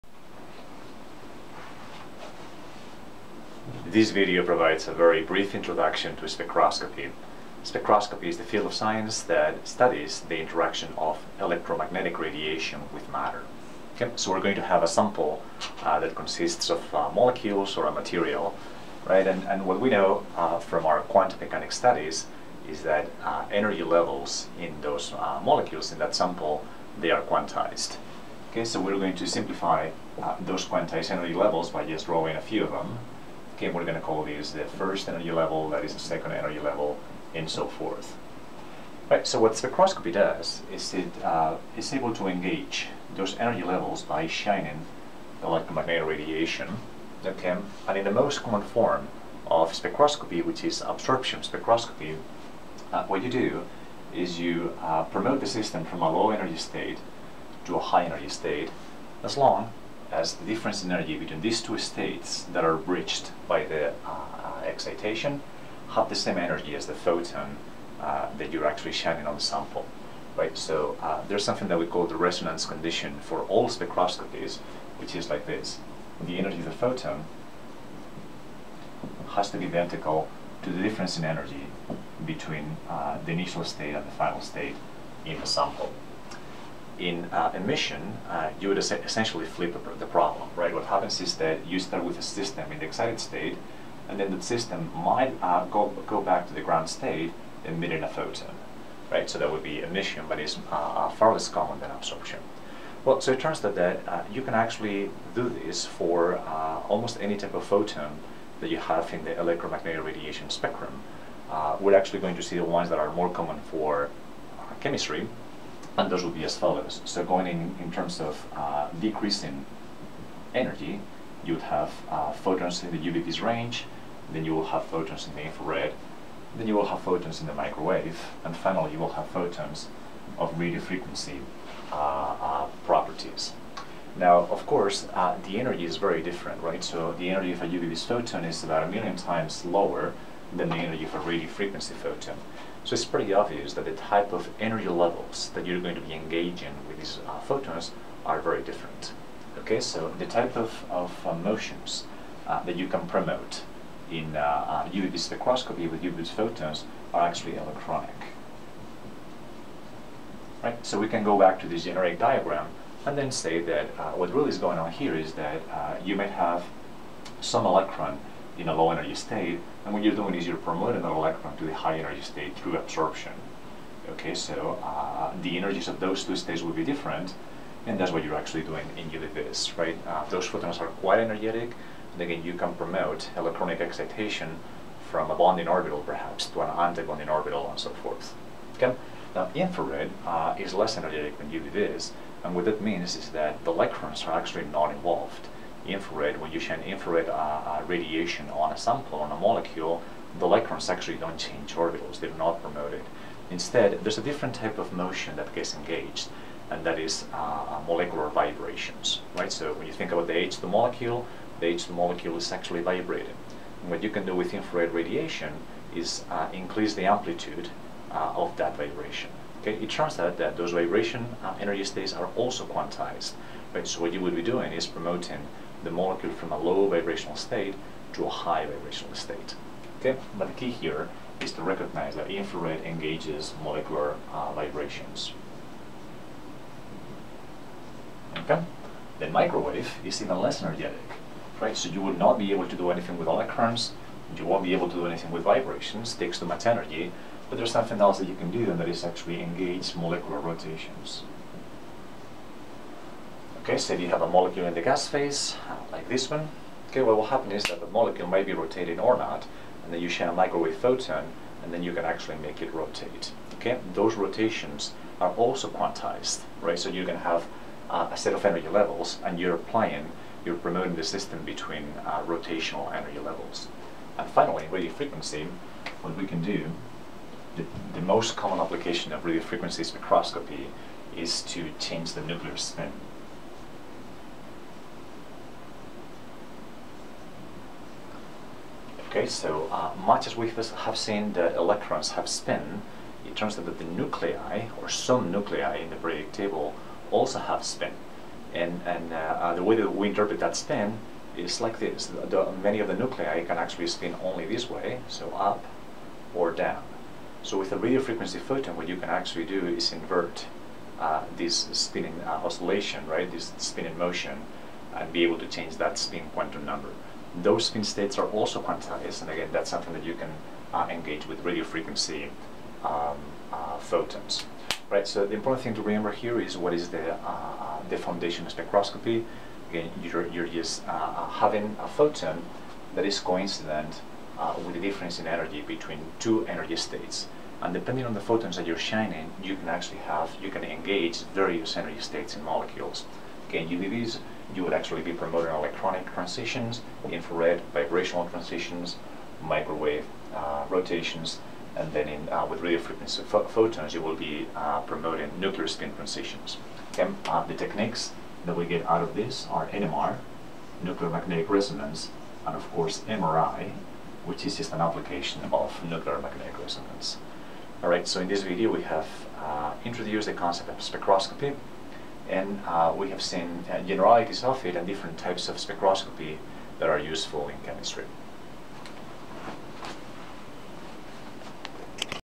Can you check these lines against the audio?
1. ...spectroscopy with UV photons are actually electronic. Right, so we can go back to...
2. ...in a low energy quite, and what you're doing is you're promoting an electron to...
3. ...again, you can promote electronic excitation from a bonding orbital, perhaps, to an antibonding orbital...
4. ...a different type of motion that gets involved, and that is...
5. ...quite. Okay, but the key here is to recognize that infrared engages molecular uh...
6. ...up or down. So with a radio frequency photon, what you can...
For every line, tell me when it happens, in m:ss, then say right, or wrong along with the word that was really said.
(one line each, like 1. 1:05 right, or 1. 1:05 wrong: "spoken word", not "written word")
1. 2:35 right
2. 2:48 wrong: "state", not "quite"
3. 3:02 right
4. 3:24 wrong: "engaged", not "involved"
5. 3:49 wrong: "state", not "quite"
6. 5:05 right.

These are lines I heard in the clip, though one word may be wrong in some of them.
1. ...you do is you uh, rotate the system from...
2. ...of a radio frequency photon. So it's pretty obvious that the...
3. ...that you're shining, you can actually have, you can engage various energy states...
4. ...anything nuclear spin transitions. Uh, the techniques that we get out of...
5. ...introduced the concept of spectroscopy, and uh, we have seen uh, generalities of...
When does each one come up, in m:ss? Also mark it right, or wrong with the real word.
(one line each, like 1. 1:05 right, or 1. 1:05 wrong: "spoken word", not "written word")
1. 0:53 wrong: "promote", not "rotate"
2. 2:21 right
3. 5:38 right
4. 5:54 wrong: "promoting", not "anything"
5. 6:09 right.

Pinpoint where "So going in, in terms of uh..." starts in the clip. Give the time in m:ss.
1:57.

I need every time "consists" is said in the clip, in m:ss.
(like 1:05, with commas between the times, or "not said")
0:16.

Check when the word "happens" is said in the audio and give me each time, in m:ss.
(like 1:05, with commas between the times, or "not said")
1:30, 4:17.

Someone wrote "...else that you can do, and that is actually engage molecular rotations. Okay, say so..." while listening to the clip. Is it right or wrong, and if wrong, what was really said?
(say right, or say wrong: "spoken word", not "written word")
right.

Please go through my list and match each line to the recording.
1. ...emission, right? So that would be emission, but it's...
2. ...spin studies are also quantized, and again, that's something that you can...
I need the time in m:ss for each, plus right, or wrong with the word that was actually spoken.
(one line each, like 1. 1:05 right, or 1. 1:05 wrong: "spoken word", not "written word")
1. 1:38 wrong: "photon", not "emission"
2. 5:17 wrong: "states", not "studies".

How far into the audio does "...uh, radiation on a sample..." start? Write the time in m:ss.
3:17.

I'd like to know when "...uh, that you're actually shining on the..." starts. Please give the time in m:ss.
1:08.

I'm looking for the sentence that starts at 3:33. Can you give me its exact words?
And what you can do with infrared radiation is uh, increase the amplitude uh, of that vibration.